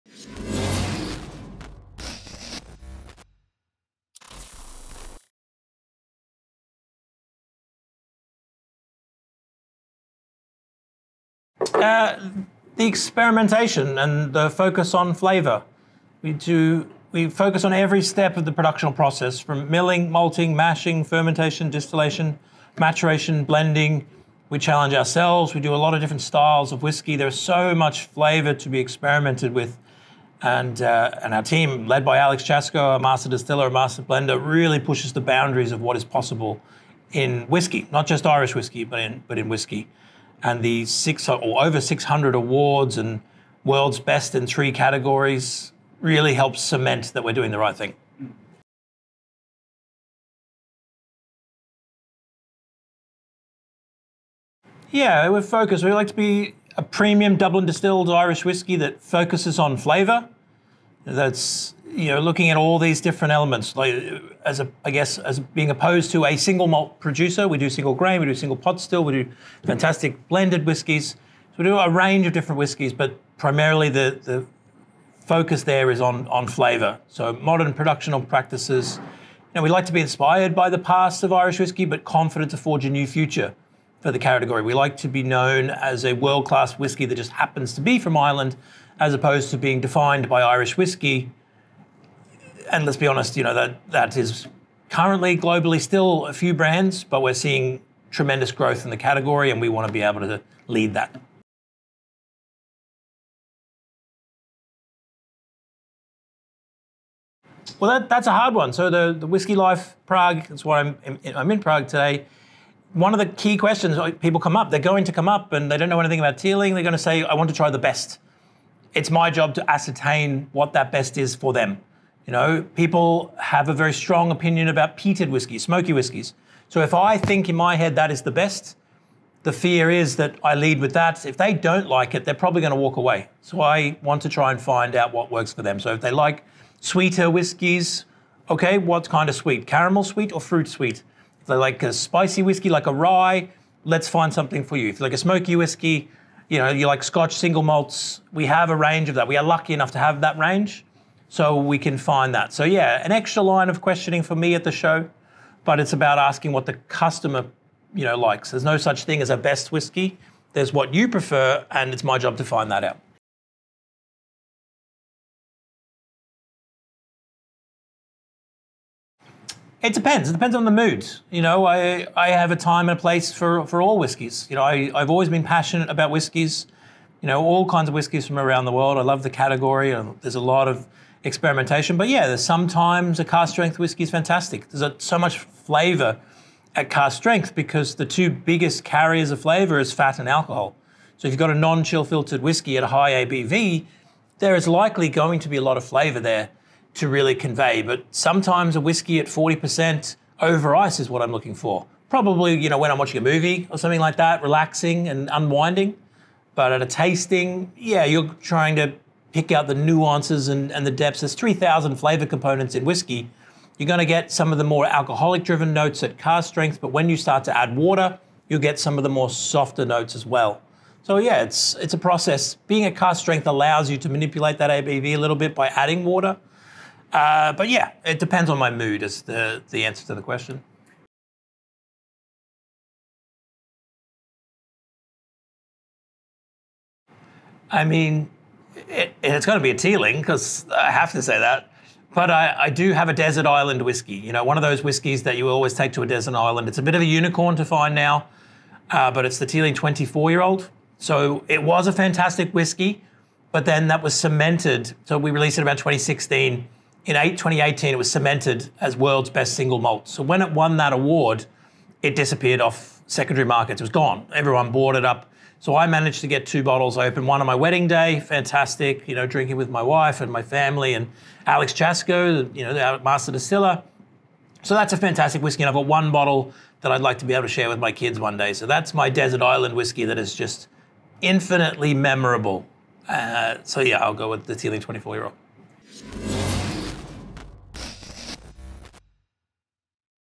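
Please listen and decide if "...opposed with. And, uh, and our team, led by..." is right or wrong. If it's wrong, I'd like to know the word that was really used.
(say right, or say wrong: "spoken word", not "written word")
wrong: "experimented", not "opposed".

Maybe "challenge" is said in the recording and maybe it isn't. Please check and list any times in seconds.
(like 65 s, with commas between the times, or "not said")
24 s.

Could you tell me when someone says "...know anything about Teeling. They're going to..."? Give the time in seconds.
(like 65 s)
115 s.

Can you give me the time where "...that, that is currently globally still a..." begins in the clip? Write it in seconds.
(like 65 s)
93 s.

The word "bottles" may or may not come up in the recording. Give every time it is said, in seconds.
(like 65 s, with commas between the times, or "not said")
266 s, 276 s.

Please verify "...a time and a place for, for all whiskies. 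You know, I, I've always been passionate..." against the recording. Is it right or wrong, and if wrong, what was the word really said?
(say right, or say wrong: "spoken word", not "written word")
right.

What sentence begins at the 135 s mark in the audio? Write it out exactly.
So if they like sweeter whiskies, okay, what kind of sweet?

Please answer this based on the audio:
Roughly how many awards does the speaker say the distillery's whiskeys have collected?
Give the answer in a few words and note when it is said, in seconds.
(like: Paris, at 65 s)
600, at 41 s.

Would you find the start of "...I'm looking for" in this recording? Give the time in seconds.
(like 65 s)
201 s.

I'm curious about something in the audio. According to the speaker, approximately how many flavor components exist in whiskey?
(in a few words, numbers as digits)
3,000.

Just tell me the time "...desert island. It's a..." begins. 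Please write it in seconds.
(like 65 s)
246 s.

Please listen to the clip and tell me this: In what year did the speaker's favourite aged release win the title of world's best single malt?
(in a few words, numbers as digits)
2018.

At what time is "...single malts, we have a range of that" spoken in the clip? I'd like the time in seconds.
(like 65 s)
147 s.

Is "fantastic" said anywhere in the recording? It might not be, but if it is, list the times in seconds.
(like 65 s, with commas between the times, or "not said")
69 s, 184 s, 251 s, 268 s, 274 s.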